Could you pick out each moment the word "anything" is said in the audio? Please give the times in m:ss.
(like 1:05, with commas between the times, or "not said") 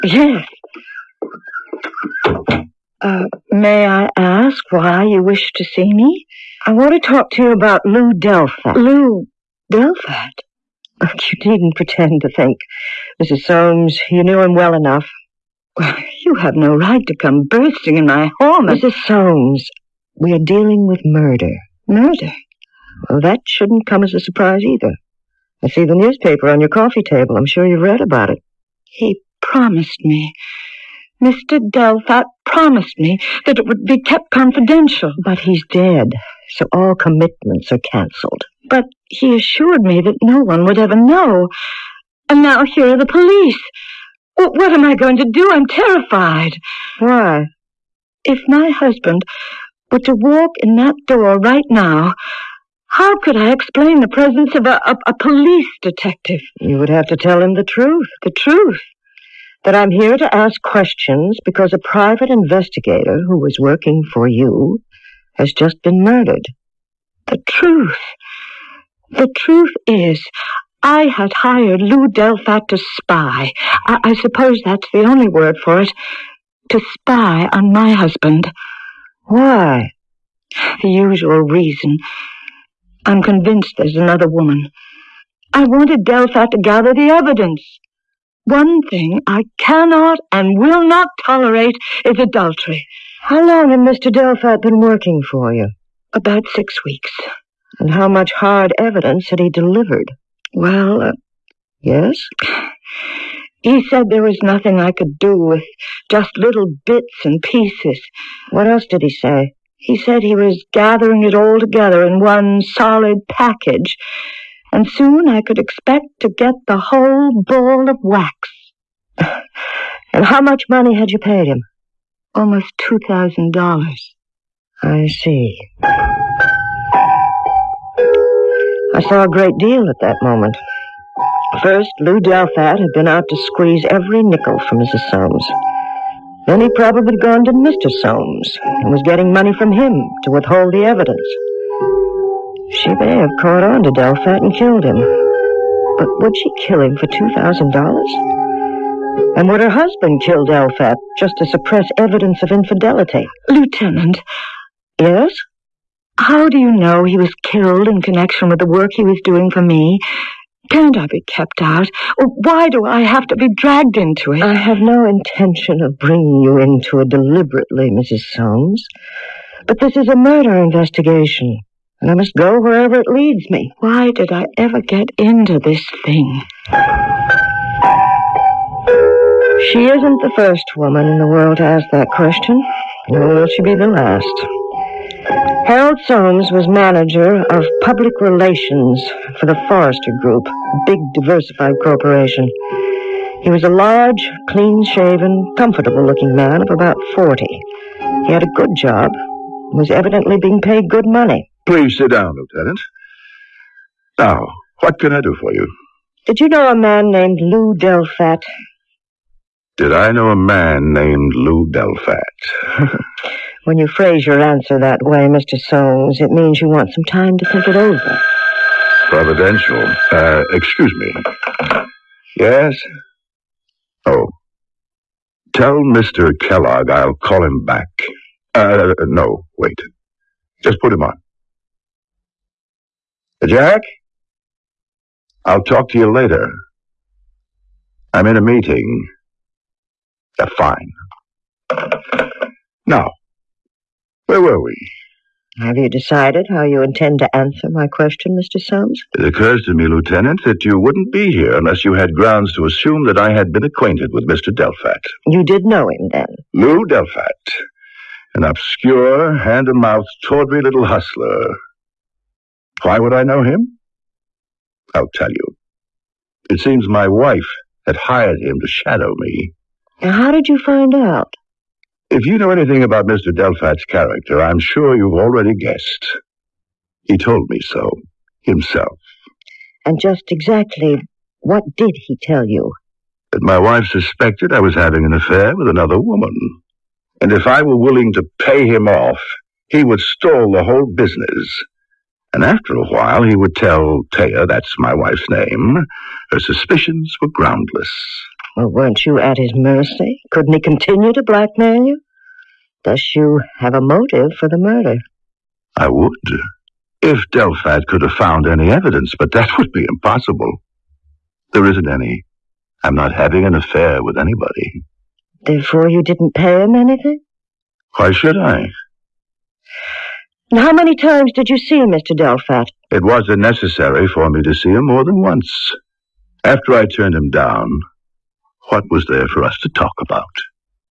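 4:32, 5:16.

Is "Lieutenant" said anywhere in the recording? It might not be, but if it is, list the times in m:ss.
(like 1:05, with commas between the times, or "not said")
2:33, 3:22, 4:09.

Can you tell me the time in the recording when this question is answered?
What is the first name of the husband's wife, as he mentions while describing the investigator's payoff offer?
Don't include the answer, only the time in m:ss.
4:54.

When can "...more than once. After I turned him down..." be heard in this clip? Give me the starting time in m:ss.
5:24.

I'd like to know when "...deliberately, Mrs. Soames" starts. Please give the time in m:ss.
2:47.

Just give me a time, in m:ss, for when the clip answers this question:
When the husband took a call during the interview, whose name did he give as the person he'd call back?
3:45.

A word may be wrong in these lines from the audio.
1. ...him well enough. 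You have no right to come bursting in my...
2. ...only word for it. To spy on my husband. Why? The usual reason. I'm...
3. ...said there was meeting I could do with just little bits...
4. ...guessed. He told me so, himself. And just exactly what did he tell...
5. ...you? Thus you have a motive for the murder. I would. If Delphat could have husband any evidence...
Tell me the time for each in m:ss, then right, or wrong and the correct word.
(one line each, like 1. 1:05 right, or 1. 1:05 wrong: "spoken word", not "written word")
1. 0:14 right
2. 1:15 right
3. 1:43 wrong: "nothing", not "meeting"
4. 4:35 right
5. 5:01 wrong: "found", not "husband".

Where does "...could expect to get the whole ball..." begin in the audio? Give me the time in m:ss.
1:55.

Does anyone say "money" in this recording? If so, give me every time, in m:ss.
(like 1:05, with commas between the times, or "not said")
2:00, 2:19, 3:21.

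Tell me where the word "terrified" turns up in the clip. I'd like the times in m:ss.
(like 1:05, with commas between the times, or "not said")
0:45.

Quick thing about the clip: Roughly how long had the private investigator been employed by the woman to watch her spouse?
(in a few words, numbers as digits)
About six weeks.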